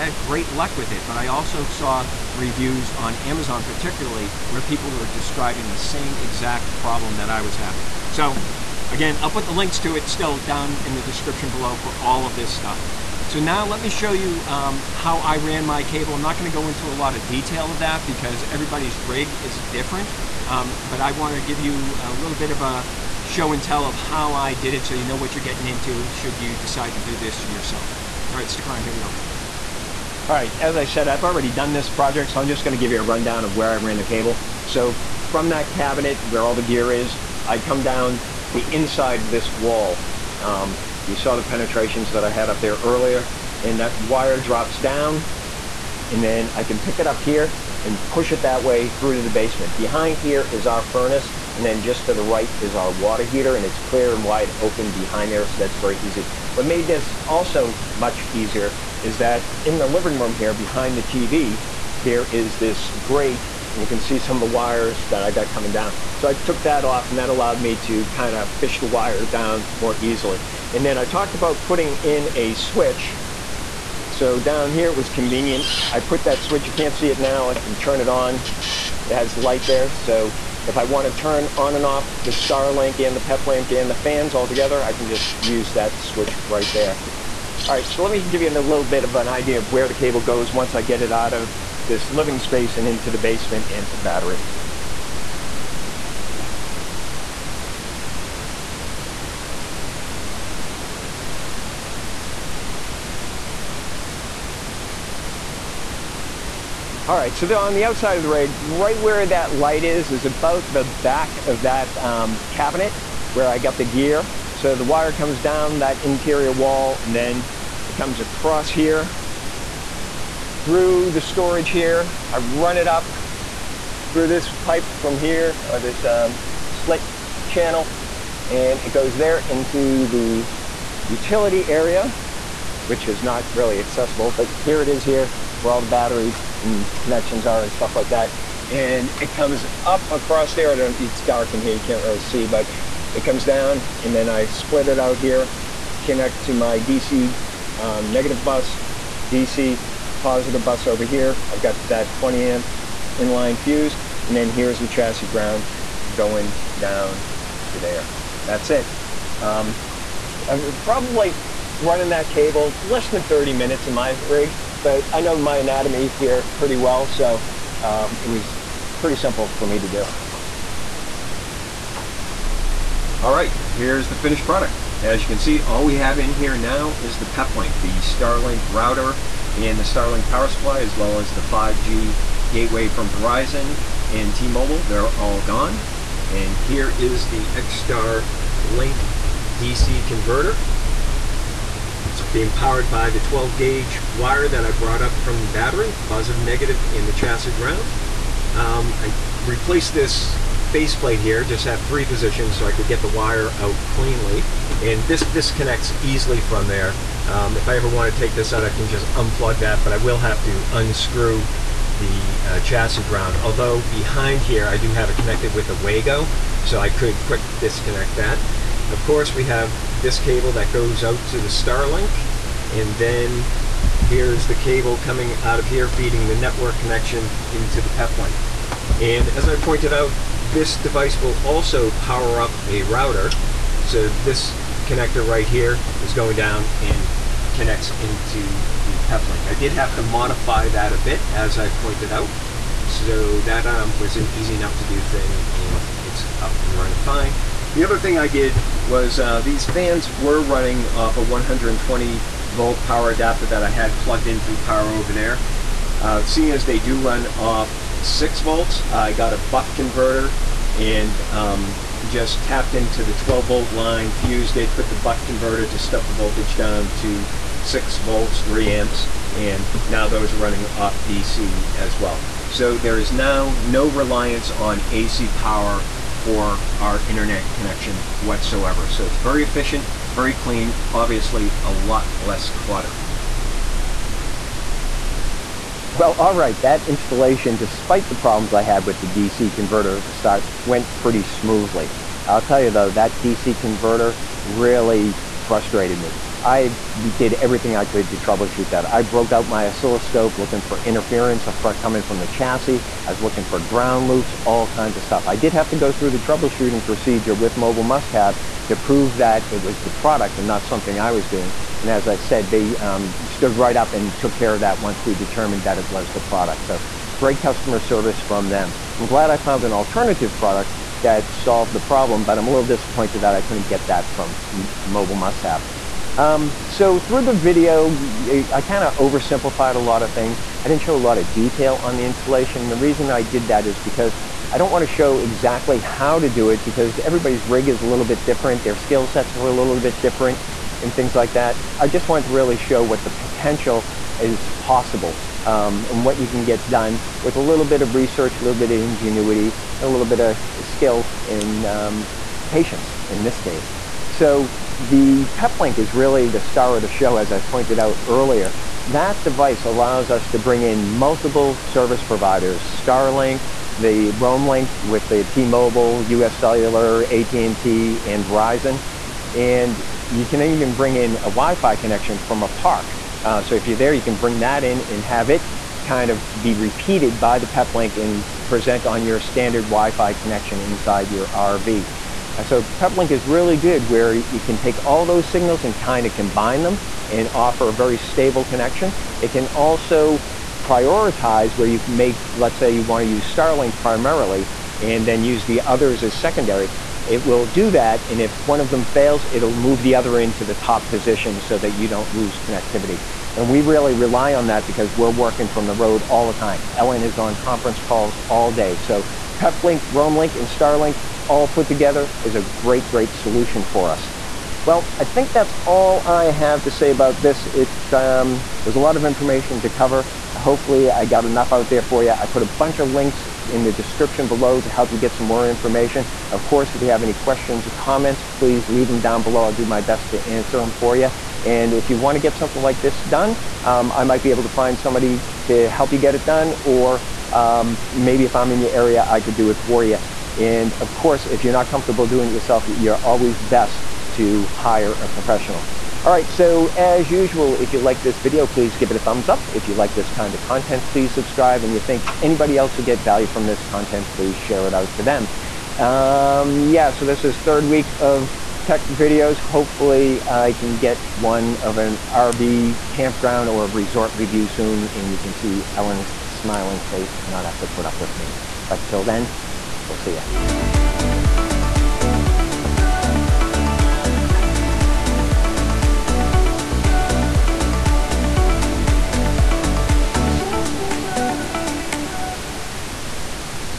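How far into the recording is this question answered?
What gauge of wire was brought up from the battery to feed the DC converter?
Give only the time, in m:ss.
3:13.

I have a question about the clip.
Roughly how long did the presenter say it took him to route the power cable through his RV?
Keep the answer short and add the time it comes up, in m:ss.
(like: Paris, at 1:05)
less than 30 minutes, at 2:42.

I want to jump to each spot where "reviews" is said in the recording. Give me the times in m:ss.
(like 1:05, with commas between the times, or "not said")
0:02, 7:44.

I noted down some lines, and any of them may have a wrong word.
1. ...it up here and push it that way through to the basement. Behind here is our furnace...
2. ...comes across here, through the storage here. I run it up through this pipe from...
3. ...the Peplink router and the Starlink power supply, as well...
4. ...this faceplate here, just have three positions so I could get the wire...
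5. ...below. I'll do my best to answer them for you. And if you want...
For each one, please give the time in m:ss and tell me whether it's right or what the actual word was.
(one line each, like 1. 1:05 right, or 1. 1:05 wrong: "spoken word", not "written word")
1. 0:46 right
2. 1:57 right
3. 2:57 wrong: "Starlink", not "Peplink"
4. 3:19 right
5. 7:09 right.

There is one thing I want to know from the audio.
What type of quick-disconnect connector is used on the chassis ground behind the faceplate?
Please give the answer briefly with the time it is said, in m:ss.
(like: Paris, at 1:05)
Wago, at 3:35.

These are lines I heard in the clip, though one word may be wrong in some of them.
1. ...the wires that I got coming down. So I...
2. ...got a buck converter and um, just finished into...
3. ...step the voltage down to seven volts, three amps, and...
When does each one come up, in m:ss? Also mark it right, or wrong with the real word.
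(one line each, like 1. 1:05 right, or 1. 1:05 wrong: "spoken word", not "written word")
1. 1:04 right
2. 4:19 wrong: "tapped", not "finished"
3. 4:25 wrong: "six", not "seven".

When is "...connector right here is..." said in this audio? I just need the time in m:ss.
3:54.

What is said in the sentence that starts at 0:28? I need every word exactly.
All right, stick around, here we go.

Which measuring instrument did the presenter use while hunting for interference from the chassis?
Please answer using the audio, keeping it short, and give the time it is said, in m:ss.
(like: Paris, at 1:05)
oscilloscope, at 4:59.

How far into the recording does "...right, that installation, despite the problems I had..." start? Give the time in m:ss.
4:46.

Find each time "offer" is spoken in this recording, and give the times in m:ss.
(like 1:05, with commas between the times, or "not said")
6:27.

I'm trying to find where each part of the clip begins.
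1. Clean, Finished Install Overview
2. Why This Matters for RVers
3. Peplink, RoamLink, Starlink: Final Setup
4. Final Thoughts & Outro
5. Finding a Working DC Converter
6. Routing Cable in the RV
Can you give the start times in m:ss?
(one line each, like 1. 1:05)
1. 3:54
2. 5:54
3. 4:54
4. 6:54
5. 0:39
6. 1:54.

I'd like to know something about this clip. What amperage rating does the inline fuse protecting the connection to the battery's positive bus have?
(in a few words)
20 amp.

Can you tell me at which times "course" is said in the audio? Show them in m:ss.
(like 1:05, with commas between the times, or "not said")
3:39, 7:06, 7:20.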